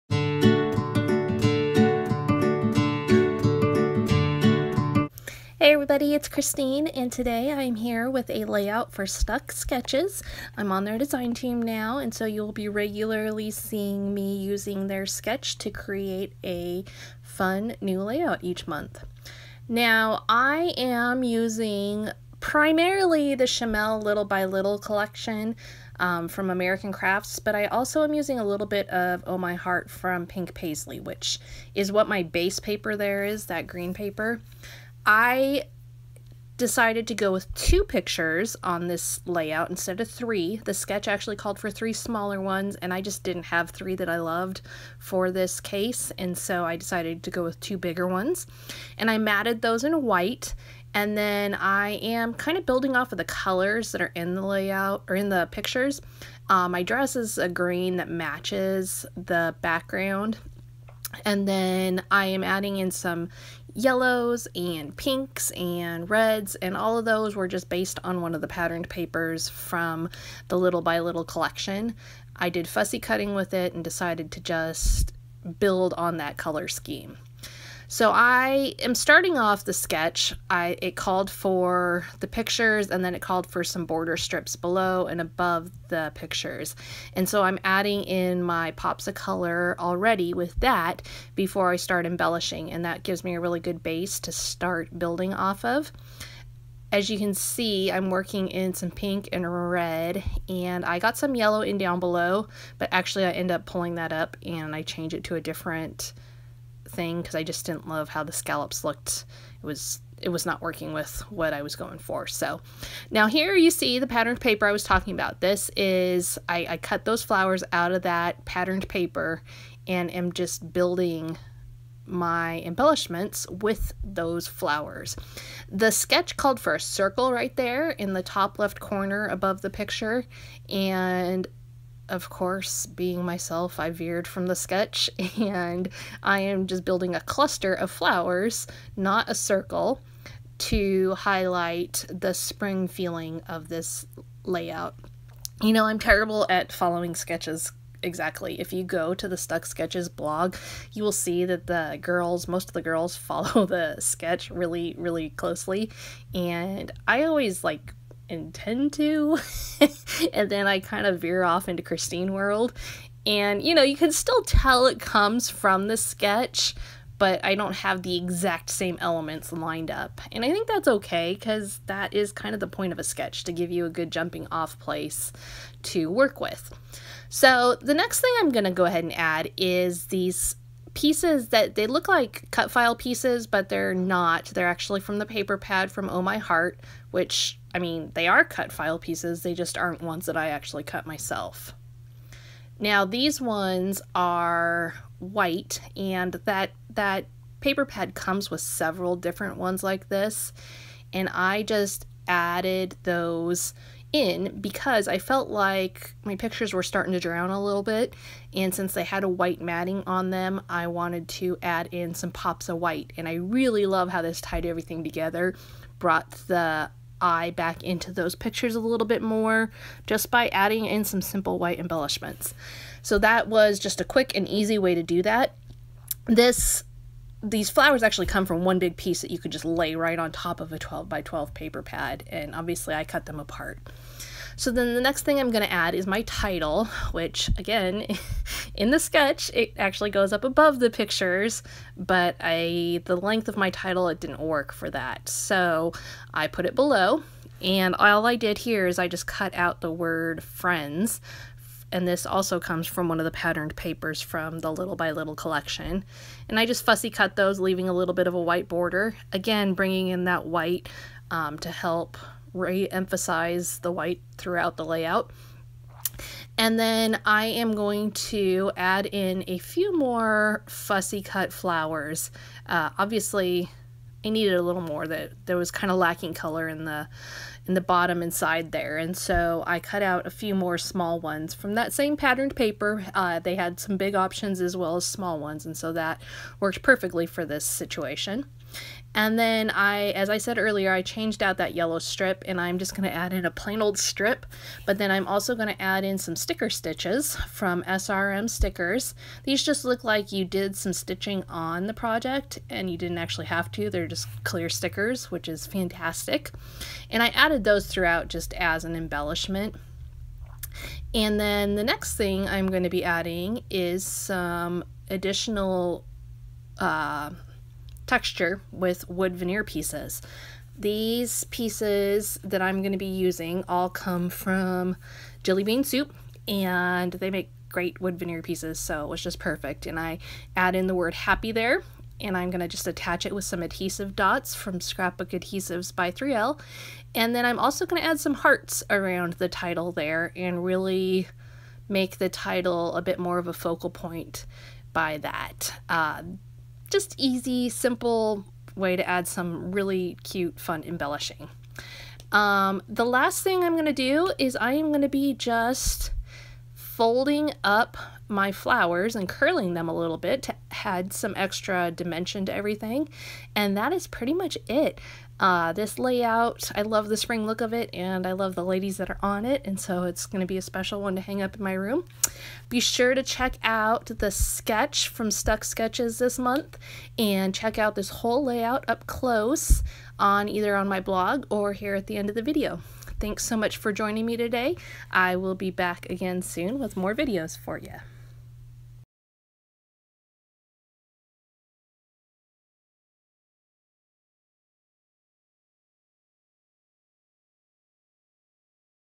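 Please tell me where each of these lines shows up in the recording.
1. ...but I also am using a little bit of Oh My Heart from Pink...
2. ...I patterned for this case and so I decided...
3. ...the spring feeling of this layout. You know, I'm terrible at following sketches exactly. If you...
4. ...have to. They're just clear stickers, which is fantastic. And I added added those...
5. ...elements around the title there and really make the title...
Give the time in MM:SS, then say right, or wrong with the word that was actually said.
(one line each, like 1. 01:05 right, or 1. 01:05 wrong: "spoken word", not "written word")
1. 00:27 right
2. 00:44 wrong: "loved", not "patterned"
3. 02:22 right
4. 05:03 right
5. 05:38 wrong: "hearts", not "elements".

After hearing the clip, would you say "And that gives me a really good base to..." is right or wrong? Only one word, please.
right.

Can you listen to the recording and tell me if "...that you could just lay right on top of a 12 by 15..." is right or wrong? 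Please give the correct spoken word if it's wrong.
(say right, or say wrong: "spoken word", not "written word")
wrong: "12", not "15".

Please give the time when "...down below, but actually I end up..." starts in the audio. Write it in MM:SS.
01:41.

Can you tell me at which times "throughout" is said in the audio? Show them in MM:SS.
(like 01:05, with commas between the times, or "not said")
04:24, 05:07.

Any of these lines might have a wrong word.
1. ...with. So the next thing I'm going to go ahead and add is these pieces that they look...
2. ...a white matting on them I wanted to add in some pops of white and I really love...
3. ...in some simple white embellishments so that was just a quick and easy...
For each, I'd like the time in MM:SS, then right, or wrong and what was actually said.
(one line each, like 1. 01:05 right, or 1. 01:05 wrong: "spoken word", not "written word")
1. 02:56 right
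2. 03:29 right
3. 03:40 right.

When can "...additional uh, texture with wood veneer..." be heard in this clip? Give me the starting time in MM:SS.
05:15.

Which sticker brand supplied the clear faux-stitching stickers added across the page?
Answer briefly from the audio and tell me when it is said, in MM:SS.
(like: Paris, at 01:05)
SRM stickers, at 04:57.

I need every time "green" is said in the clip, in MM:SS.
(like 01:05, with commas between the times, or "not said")
00:33, 00:57.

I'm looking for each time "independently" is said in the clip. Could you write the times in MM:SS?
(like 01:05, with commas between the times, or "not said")
not said.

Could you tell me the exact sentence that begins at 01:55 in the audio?
This is, I, I cut those flowers out of that patterned paper and am just building my embellishments with those flowers.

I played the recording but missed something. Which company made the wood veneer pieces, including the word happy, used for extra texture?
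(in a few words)
Jillibean Soup.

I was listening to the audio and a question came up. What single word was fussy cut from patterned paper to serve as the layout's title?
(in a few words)
friends.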